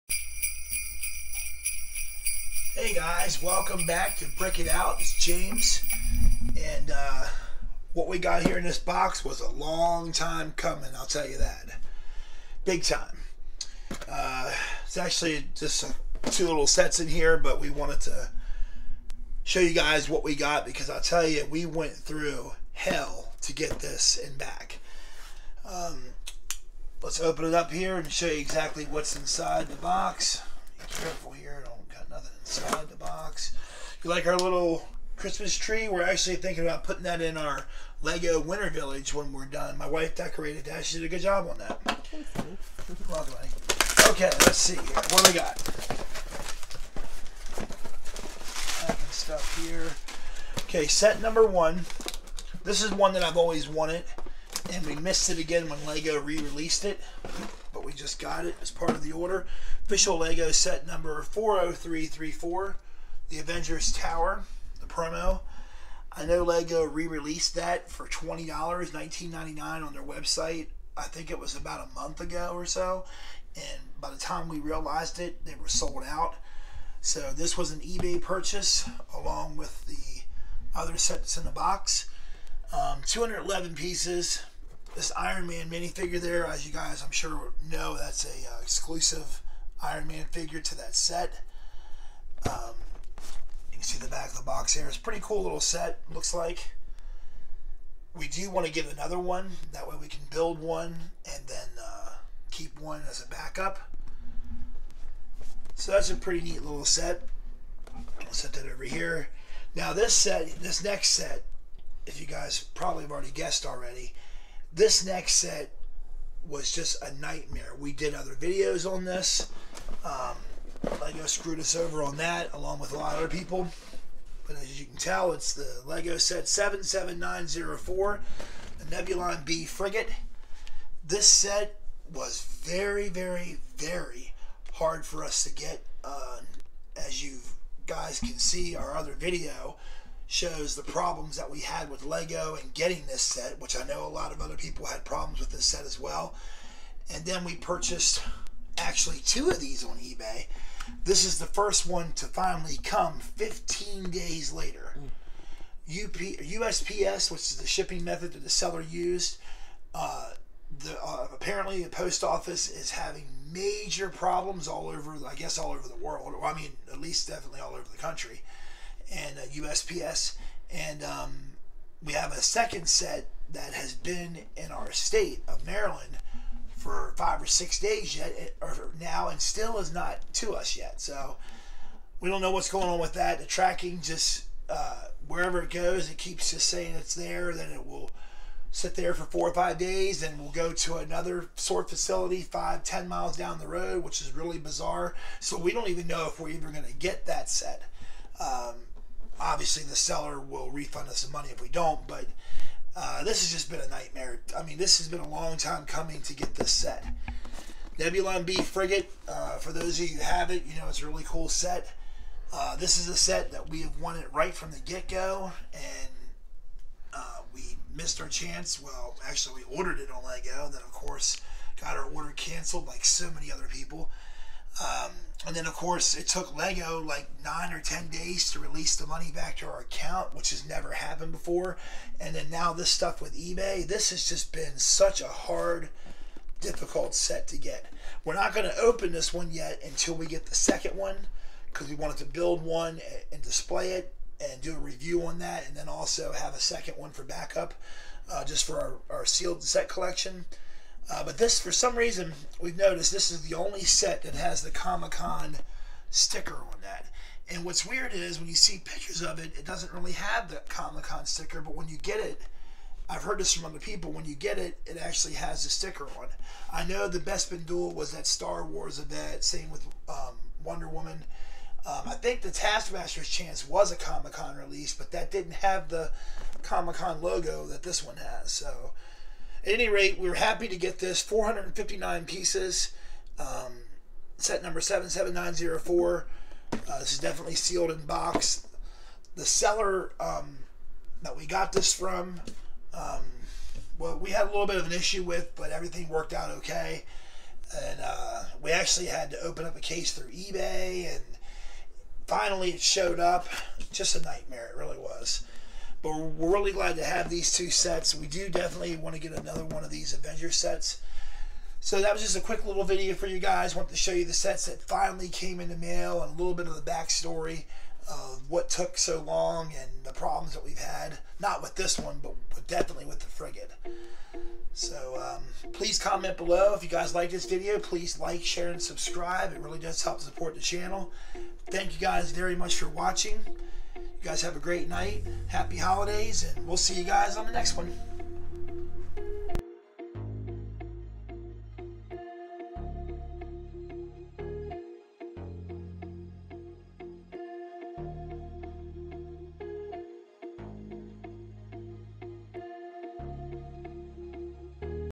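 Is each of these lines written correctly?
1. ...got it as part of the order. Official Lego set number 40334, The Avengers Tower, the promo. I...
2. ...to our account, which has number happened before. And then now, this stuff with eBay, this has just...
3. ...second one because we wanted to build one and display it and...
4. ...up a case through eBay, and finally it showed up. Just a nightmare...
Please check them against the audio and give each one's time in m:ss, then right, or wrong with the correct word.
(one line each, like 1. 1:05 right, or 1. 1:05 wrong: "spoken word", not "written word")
1. 0:58 right
2. 3:49 wrong: "never", not "number"
3. 4:00 right
4. 4:59 right.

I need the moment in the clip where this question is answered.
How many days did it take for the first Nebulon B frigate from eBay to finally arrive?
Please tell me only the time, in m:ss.
2:33.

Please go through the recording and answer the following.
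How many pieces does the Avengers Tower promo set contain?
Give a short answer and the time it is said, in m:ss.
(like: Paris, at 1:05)
211, at 1:23.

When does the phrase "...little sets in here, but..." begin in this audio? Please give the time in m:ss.
0:16.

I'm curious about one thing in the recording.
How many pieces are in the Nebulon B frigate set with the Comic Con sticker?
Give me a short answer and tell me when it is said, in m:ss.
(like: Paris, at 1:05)
459, at 4:41.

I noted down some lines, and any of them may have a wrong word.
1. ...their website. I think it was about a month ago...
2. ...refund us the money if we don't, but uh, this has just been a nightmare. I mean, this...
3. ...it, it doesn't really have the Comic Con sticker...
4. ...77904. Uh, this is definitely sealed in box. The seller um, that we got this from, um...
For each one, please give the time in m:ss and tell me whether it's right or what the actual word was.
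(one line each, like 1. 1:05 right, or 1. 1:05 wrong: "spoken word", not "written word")
1. 1:09 right
2. 3:20 right
3. 4:19 right
4. 4:44 right.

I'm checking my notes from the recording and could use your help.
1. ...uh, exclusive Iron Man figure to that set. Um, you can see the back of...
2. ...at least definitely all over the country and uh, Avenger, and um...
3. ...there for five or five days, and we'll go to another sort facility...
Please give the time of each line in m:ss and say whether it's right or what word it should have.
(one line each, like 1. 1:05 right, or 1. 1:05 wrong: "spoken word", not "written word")
1. 1:28 right
2. 2:46 wrong: "USPS", not "Avenger"
3. 3:08 wrong: "four", not "five".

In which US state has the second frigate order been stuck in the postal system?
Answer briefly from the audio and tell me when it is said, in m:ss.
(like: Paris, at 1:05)
Maryland, at 2:55.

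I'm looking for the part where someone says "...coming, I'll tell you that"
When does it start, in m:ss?
0:10.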